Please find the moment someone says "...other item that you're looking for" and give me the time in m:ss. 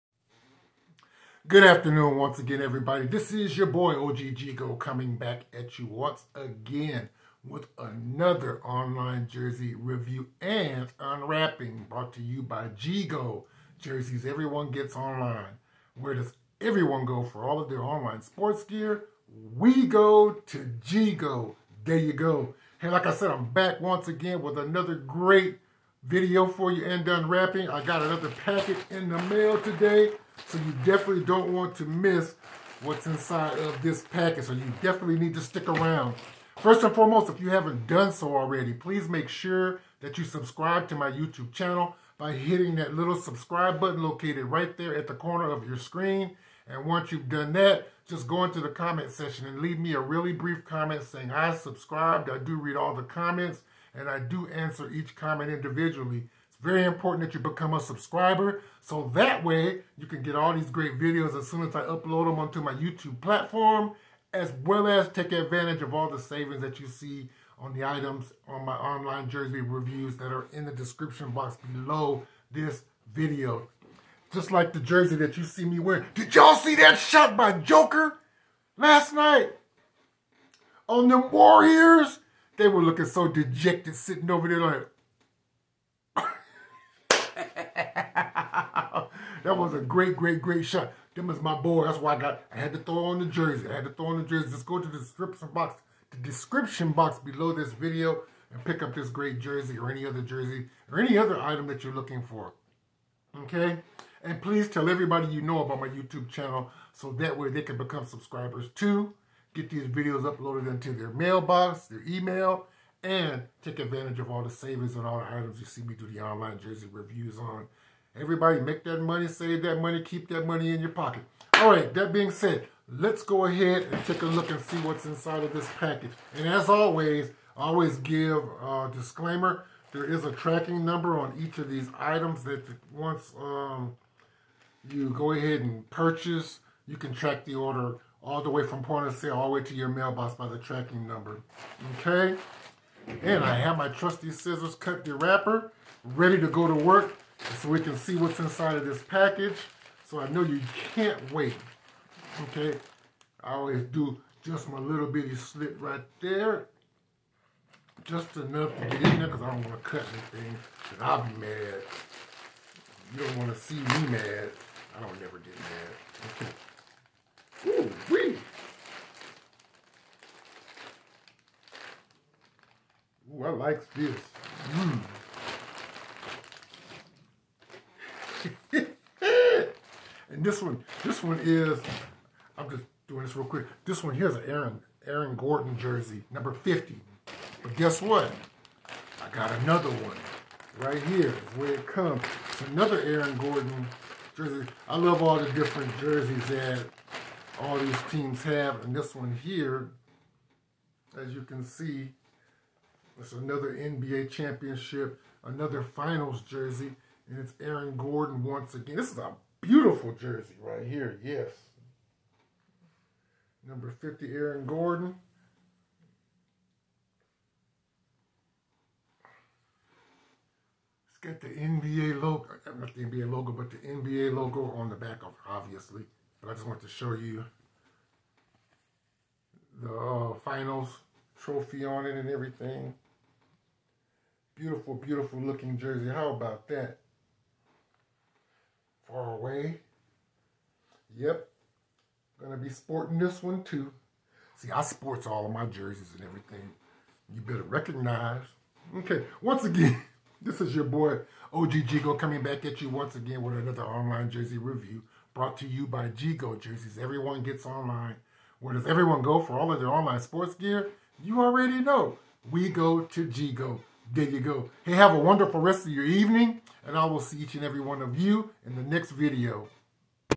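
1:41.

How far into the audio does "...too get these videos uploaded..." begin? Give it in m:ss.
1:48.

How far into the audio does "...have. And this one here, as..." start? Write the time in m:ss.
3:18.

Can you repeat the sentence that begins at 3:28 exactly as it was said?
This is a beautiful jersey right here, yes.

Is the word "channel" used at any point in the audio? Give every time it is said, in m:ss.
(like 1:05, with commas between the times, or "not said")
0:41, 1:46.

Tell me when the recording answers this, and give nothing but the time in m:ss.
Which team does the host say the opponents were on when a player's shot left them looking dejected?
1:21.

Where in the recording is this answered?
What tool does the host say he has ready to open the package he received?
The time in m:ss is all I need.
2:24.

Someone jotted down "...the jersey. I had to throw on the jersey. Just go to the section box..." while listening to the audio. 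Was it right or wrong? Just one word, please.
wrong.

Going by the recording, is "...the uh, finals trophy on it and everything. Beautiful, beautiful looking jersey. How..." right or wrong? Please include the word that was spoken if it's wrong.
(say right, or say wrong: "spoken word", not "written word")
right.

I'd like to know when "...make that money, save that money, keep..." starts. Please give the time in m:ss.
1:58.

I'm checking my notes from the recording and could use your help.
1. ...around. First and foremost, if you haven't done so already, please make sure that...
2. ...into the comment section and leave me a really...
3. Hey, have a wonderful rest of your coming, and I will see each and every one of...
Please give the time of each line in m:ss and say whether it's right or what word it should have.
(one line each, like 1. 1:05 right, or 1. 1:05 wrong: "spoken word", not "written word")
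1. 0:35 right
2. 0:48 right
3. 4:24 wrong: "evening", not "coming".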